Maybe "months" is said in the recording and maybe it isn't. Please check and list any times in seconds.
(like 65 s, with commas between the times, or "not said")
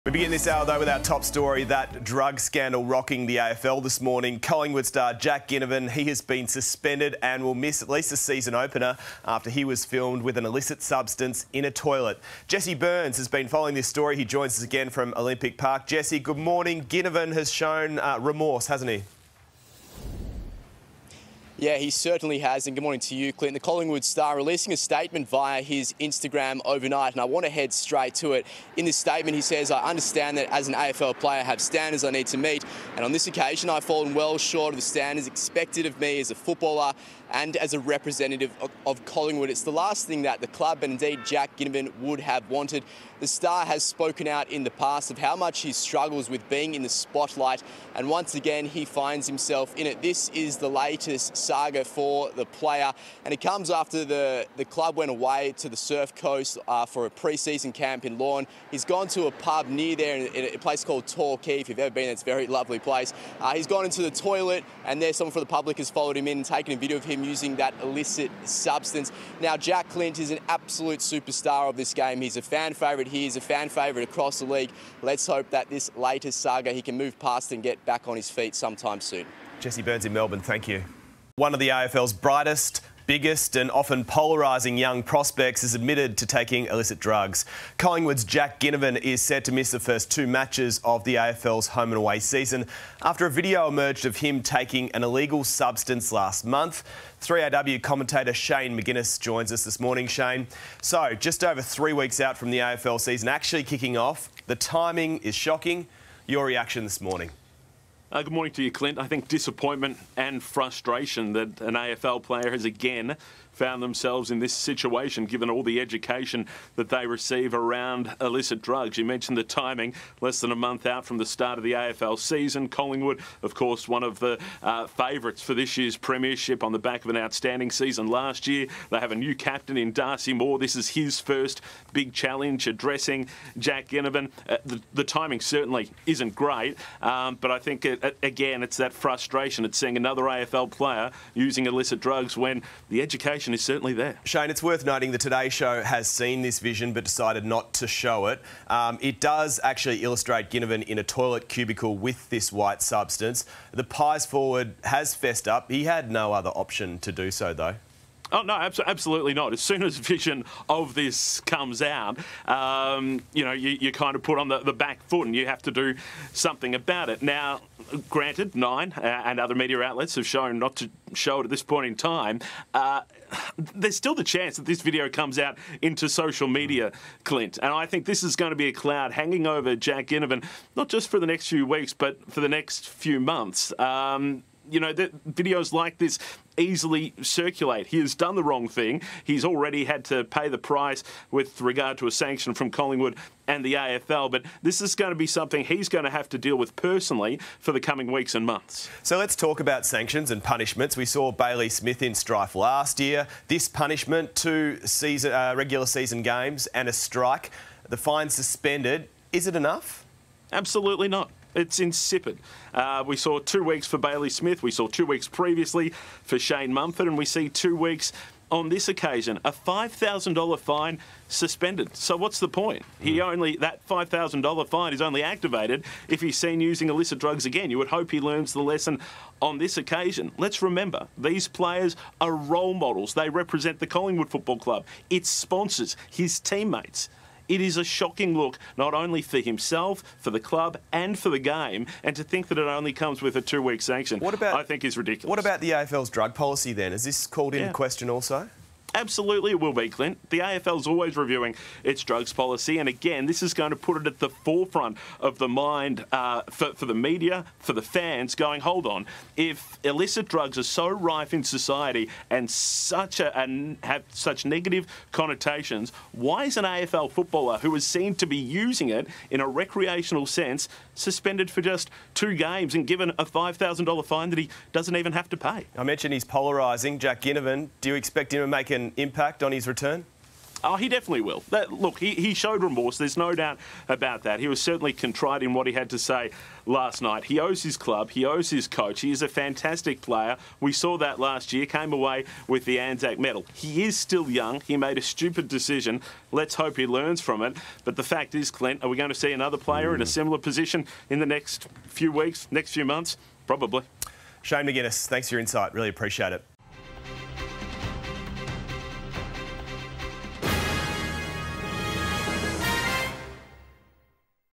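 96 s, 120 s, 183 s, 198 s, 302 s.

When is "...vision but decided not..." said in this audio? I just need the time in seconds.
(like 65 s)
146 s.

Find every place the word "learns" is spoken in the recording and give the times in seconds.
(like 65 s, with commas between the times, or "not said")
228 s, 296 s.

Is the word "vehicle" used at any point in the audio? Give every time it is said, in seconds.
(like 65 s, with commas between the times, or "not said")
not said.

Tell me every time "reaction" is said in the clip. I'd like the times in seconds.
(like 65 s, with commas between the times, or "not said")
106 s.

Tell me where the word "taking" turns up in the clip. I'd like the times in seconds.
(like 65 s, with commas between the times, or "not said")
86 s, 94 s.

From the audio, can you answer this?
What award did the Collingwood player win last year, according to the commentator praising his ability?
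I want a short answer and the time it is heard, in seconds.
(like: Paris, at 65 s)
Anzac medal, at 292 s.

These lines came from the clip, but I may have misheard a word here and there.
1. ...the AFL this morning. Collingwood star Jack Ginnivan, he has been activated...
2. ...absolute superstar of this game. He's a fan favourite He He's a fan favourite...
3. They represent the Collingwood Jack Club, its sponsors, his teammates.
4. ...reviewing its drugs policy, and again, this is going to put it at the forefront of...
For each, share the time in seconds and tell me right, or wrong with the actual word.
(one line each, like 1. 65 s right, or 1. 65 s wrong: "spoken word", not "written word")
1. 3 s wrong: "suspended", not "activated"
2. 70 s right
3. 233 s wrong: "Football", not "Jack"
4. 251 s right.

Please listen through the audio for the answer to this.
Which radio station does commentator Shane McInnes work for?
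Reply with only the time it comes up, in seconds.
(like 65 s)
97 s.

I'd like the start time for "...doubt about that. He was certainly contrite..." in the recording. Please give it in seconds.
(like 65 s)
283 s.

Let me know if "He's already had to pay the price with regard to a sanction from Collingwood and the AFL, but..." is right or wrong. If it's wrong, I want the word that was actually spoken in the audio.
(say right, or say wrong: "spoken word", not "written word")
right.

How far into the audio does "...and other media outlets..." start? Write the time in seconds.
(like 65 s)
169 s.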